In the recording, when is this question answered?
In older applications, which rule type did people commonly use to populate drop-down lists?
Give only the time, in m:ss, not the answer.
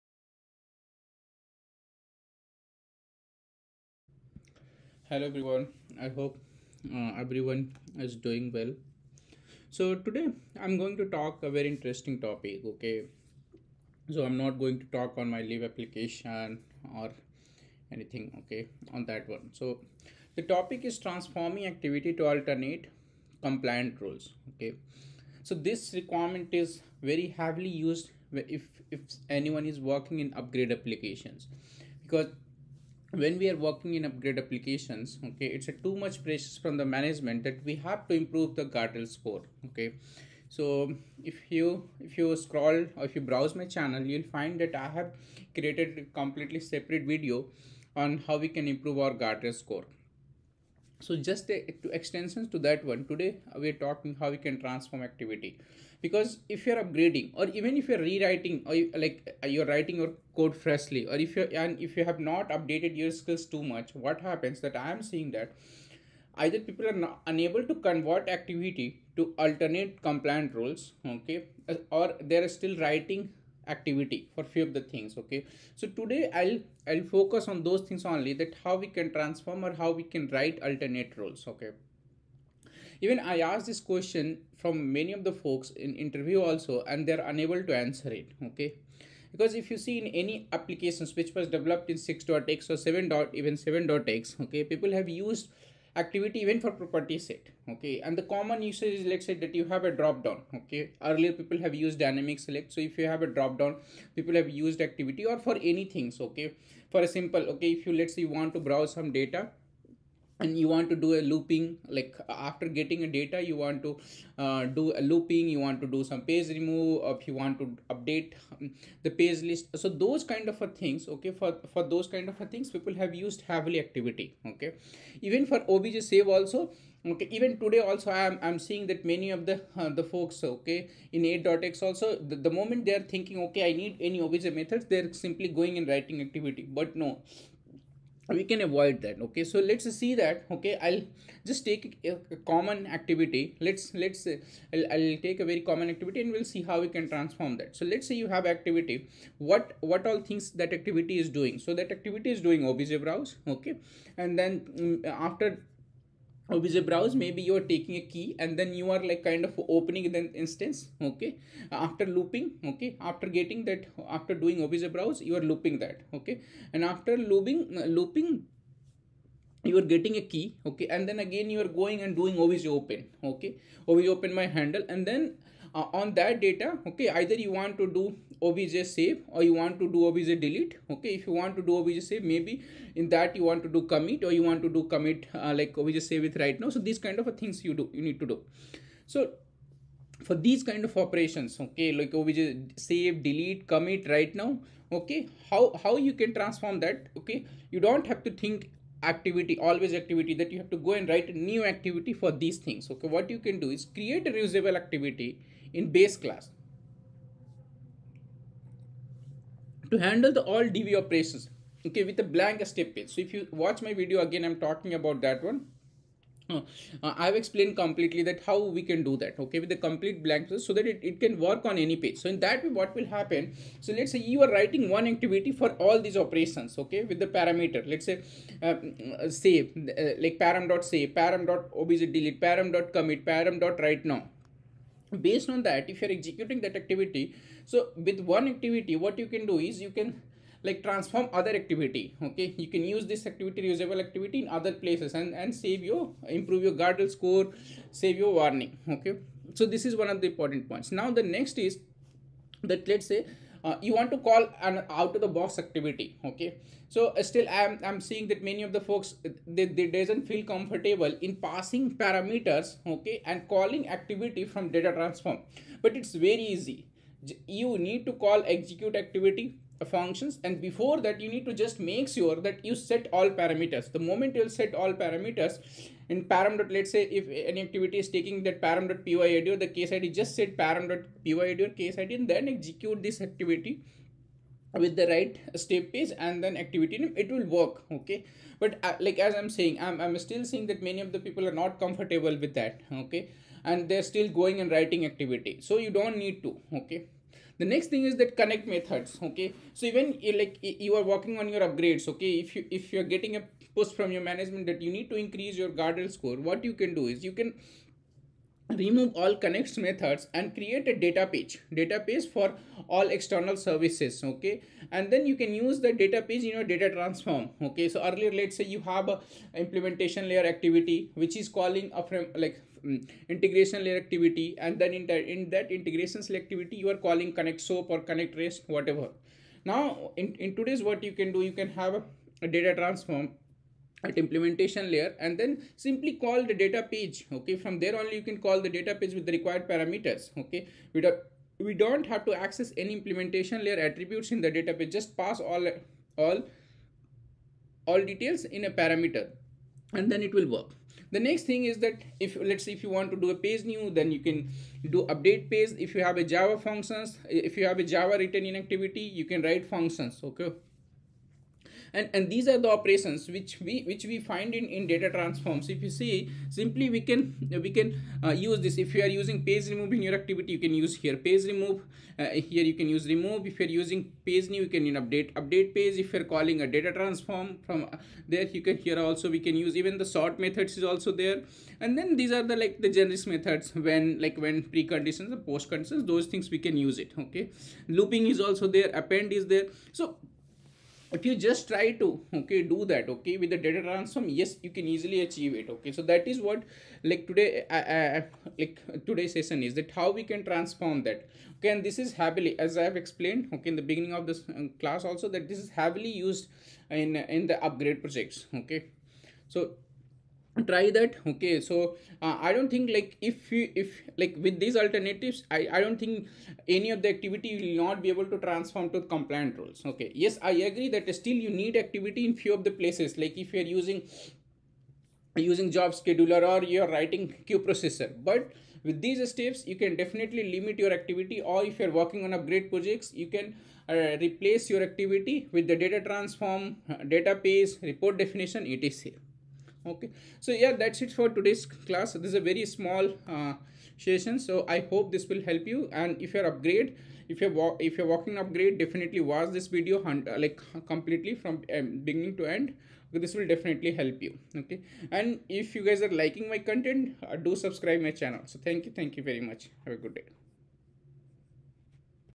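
1:41.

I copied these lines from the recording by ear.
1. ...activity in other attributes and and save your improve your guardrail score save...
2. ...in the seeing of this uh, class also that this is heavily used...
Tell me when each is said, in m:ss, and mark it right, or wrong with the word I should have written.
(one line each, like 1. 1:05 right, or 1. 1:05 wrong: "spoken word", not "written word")
1. 4:03 wrong: "places", not "attributes"
2. 6:43 wrong: "beginning", not "seeing".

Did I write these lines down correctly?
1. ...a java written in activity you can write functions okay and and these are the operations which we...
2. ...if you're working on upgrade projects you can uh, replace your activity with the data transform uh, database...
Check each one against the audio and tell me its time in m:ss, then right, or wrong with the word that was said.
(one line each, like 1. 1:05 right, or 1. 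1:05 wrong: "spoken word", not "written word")
1. 5:57 right
2. 7:11 right.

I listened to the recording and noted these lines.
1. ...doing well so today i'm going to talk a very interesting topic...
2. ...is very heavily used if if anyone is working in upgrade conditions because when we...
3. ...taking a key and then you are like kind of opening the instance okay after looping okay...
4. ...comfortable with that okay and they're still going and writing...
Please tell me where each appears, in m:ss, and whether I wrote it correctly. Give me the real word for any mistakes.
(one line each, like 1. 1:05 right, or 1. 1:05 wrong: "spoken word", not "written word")
1. 0:08 right
2. 0:26 wrong: "applications", not "conditions"
3. 2:37 right
4. 4:51 right.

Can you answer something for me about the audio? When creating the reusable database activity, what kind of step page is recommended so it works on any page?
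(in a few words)
Blank step page.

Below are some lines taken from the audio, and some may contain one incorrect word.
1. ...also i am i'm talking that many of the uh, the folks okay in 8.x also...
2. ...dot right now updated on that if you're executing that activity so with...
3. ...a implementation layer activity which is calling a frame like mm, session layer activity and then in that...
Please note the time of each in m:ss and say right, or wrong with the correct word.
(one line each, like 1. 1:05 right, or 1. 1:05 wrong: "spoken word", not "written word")
1. 2:07 wrong: "seeing", not "talking"
2. 3:53 wrong: "based", not "updated"
3. 5:19 wrong: "integration", not "session".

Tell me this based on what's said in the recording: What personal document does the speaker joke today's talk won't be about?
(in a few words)
Leave application.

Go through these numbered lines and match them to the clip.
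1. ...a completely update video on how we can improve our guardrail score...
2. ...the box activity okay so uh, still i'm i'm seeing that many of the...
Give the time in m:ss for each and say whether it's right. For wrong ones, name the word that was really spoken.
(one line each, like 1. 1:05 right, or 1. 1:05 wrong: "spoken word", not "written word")
1. 0:45 wrong: "separate", not "update"
2. 4:15 right.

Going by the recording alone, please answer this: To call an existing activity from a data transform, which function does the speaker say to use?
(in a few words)
Execute activity.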